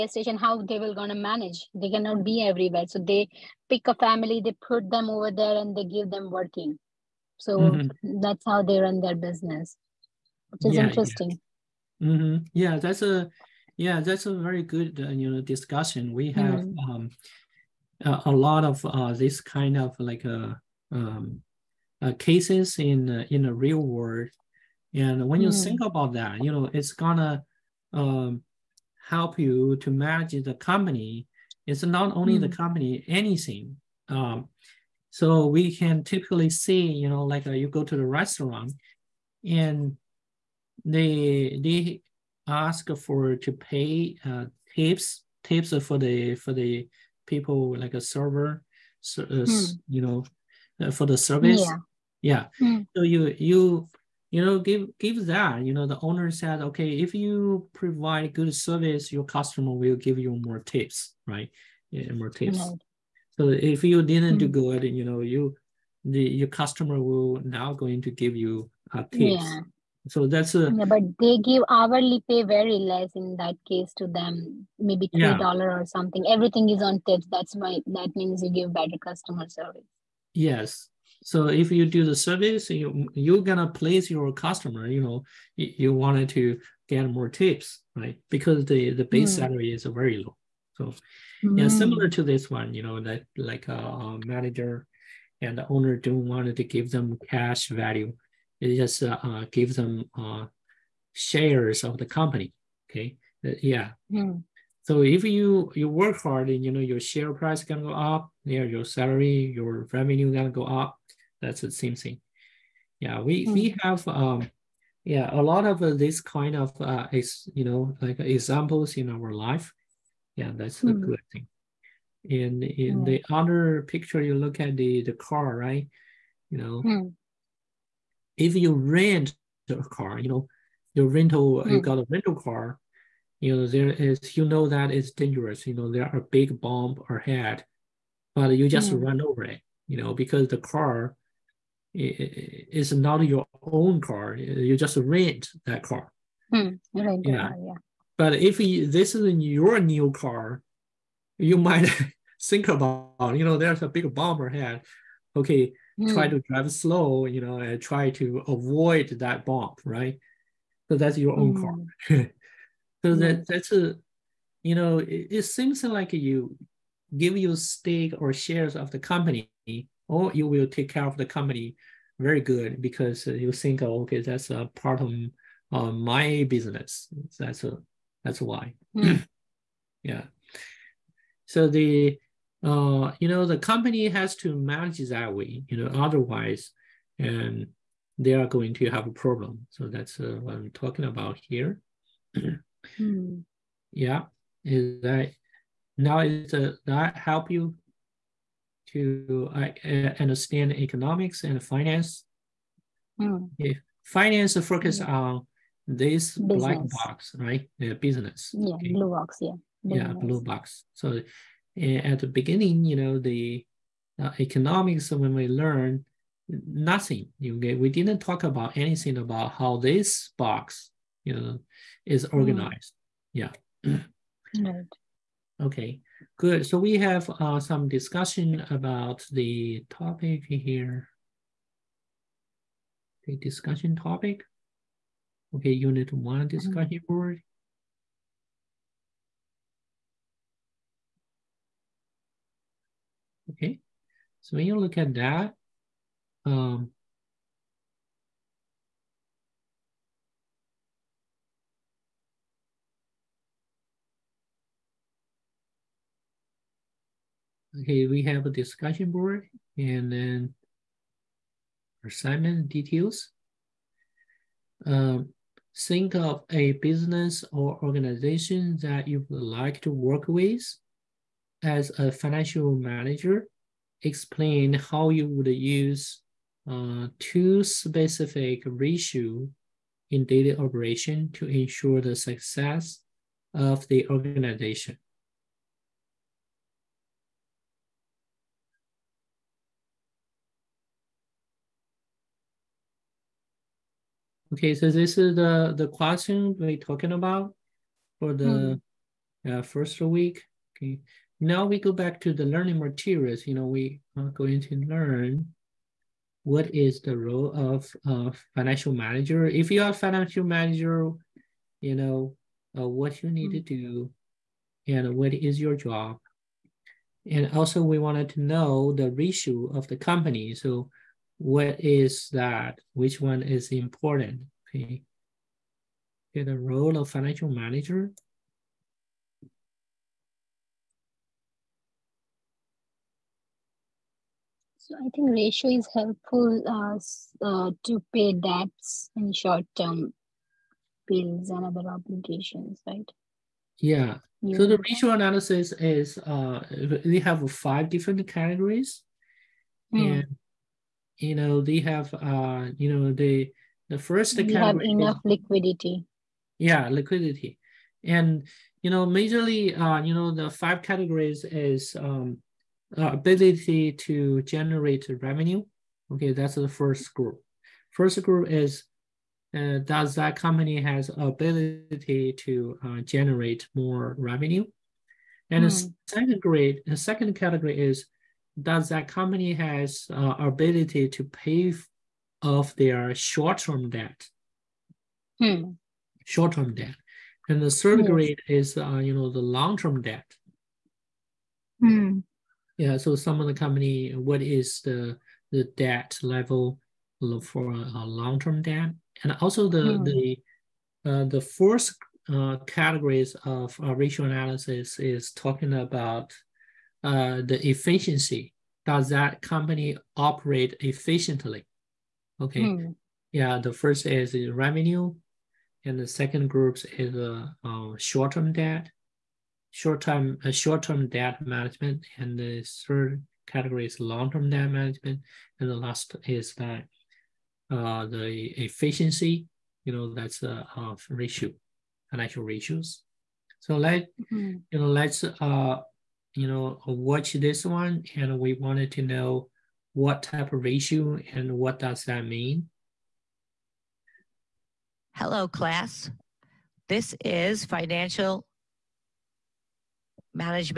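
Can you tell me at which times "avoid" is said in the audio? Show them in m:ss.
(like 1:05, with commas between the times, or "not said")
2:38.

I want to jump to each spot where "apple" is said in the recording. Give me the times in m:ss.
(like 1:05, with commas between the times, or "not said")
not said.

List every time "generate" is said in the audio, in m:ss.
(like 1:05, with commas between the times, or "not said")
6:04, 6:13.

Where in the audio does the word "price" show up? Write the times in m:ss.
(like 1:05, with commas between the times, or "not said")
1:47.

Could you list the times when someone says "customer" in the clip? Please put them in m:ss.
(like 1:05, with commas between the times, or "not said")
0:59, 1:06, 1:18, 1:24.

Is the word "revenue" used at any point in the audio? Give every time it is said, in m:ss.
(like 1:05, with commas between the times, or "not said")
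1:49, 6:05, 6:14, 6:54.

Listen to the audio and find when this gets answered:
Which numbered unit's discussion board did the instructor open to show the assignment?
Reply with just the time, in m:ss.
3:55.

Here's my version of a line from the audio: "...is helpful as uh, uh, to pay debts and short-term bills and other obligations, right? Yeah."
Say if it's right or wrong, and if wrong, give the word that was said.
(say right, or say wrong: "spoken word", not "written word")
right.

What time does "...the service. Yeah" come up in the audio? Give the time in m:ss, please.
0:51.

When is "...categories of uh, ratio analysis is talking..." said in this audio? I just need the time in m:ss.
6:42.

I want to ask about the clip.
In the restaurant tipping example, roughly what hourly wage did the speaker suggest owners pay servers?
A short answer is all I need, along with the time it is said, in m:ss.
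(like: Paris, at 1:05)
3 dollars, at 1:15.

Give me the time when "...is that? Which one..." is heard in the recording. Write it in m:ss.
5:21.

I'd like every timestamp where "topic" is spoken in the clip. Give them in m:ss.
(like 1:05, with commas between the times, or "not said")
3:49, 3:53.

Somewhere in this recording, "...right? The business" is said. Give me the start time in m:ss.
3:27.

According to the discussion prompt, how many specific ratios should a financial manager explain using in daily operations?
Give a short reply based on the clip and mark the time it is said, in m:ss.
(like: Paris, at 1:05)
2, at 4:37.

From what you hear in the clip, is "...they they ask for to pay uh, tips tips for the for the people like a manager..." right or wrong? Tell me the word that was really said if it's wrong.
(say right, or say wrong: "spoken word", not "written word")
wrong: "server", not "manager".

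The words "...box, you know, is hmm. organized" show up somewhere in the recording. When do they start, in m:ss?
3:40.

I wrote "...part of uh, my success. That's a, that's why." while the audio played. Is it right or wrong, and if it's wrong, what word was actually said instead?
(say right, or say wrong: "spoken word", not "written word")
wrong: "business", not "success".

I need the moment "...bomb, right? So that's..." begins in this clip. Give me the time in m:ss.
2:39.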